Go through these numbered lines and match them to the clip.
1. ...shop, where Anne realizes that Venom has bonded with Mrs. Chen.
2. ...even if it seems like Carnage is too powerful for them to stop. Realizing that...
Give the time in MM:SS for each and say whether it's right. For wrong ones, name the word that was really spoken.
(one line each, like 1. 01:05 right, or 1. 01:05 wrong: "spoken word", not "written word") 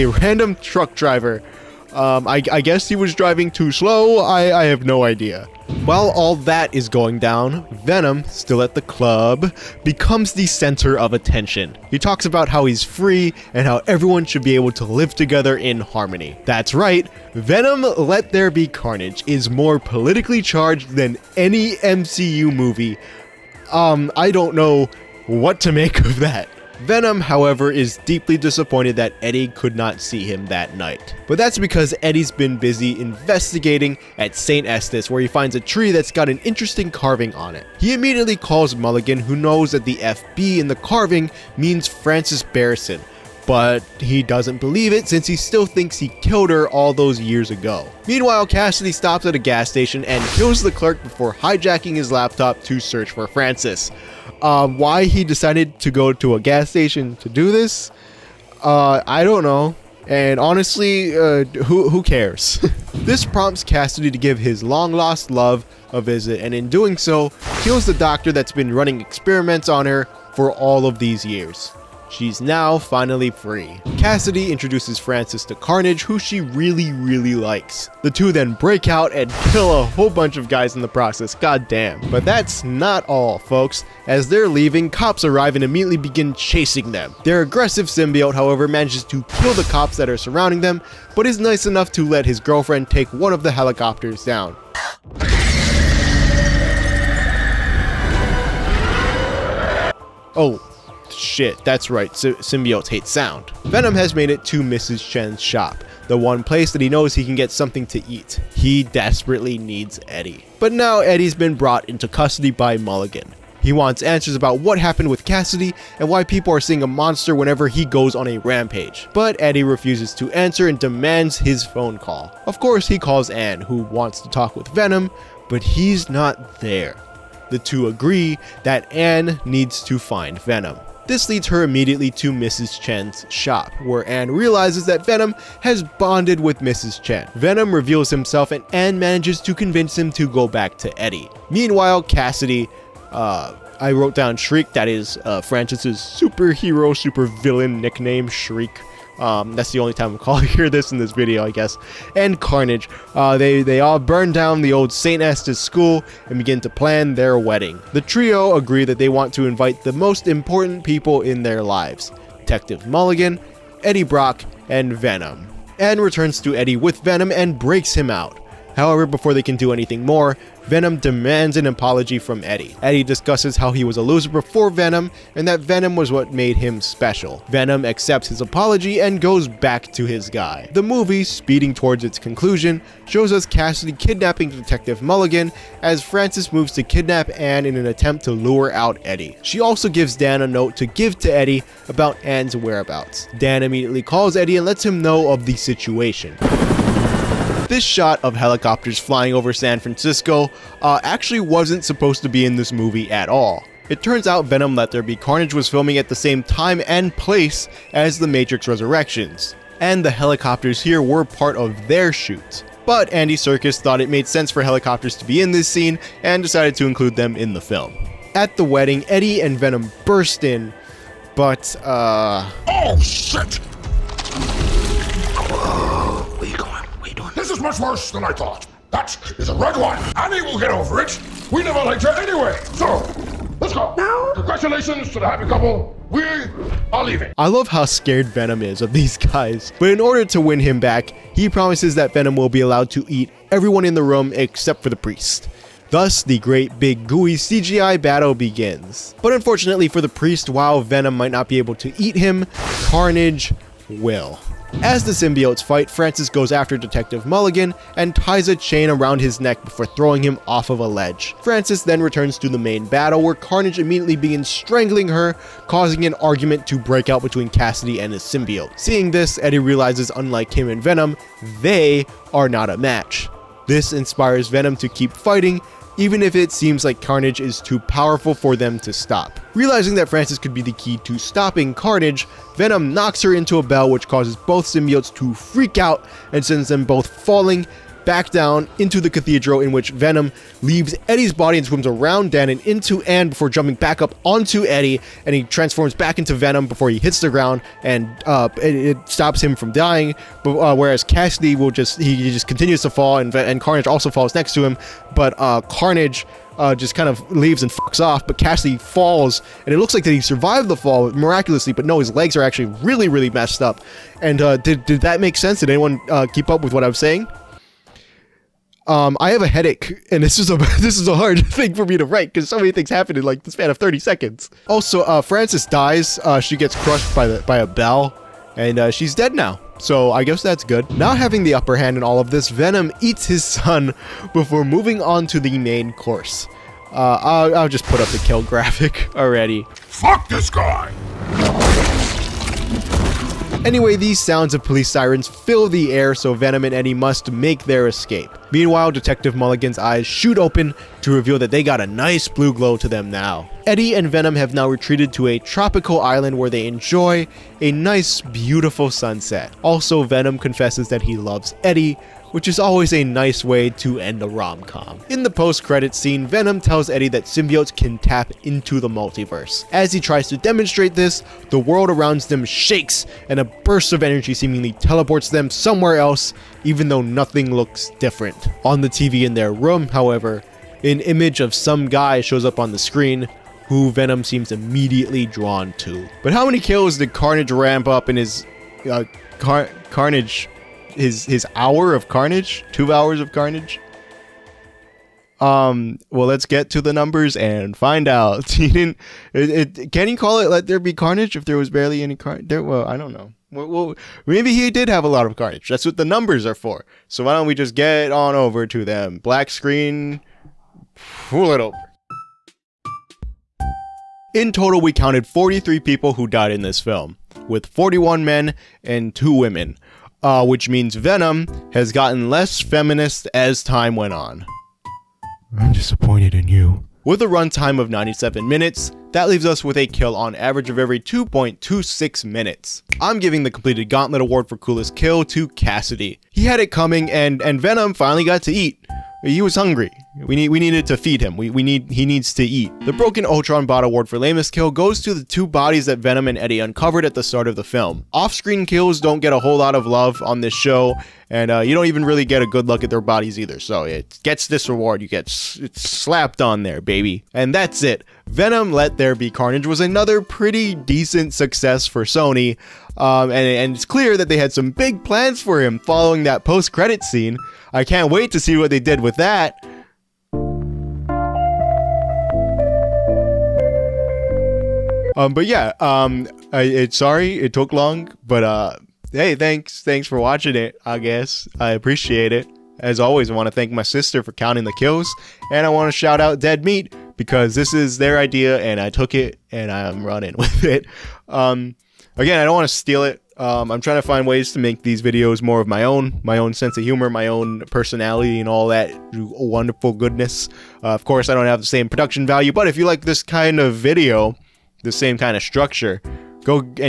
1. 02:13 right
2. 04:35 right.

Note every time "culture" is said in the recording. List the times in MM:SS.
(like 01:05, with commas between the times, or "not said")
not said.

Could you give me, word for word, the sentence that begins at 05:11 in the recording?
But no, his legs are actually really, really messed up.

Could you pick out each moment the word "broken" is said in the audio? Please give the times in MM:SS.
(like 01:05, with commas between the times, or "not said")
07:22.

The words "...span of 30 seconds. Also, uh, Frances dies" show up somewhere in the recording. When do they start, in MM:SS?
05:23.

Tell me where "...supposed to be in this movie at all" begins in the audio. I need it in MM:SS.
03:21.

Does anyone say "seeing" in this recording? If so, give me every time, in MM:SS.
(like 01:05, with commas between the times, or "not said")
01:56, 04:28.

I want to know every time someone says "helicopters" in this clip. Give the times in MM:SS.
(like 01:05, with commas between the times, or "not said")
01:33, 03:18, 03:30, 03:34.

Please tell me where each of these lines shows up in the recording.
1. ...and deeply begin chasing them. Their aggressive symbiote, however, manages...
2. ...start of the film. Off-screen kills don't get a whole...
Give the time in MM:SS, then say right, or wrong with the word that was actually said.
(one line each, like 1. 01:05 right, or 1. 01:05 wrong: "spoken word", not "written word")
1. 01:25 wrong: "immediately", not "deeply"
2. 07:27 right.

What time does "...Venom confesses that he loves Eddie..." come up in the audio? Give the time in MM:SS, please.
06:00.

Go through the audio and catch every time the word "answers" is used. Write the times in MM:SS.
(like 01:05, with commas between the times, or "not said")
01:54, 02:00.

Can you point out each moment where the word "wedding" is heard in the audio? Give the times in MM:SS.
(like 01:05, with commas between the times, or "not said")
02:37, 03:38.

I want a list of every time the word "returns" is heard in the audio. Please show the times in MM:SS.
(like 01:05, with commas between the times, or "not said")
02:45, 04:22.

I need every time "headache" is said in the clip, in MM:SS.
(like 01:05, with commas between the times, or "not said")
05:19.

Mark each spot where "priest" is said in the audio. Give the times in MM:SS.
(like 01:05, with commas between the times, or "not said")
04:04, 04:10.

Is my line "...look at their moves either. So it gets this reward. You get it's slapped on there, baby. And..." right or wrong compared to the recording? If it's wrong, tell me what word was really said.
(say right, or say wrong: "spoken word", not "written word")
wrong: "bodies", not "moves".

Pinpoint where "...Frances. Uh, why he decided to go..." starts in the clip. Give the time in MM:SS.
00:53.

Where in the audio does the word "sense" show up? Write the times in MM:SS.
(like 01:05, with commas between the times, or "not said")
03:34, 05:15, 08:16.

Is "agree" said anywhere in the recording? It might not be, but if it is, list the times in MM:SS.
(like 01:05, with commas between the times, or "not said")
02:07, 02:38.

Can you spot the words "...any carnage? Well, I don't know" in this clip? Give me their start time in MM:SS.
06:42.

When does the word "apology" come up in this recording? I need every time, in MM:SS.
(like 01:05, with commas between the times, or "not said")
02:51, 02:58.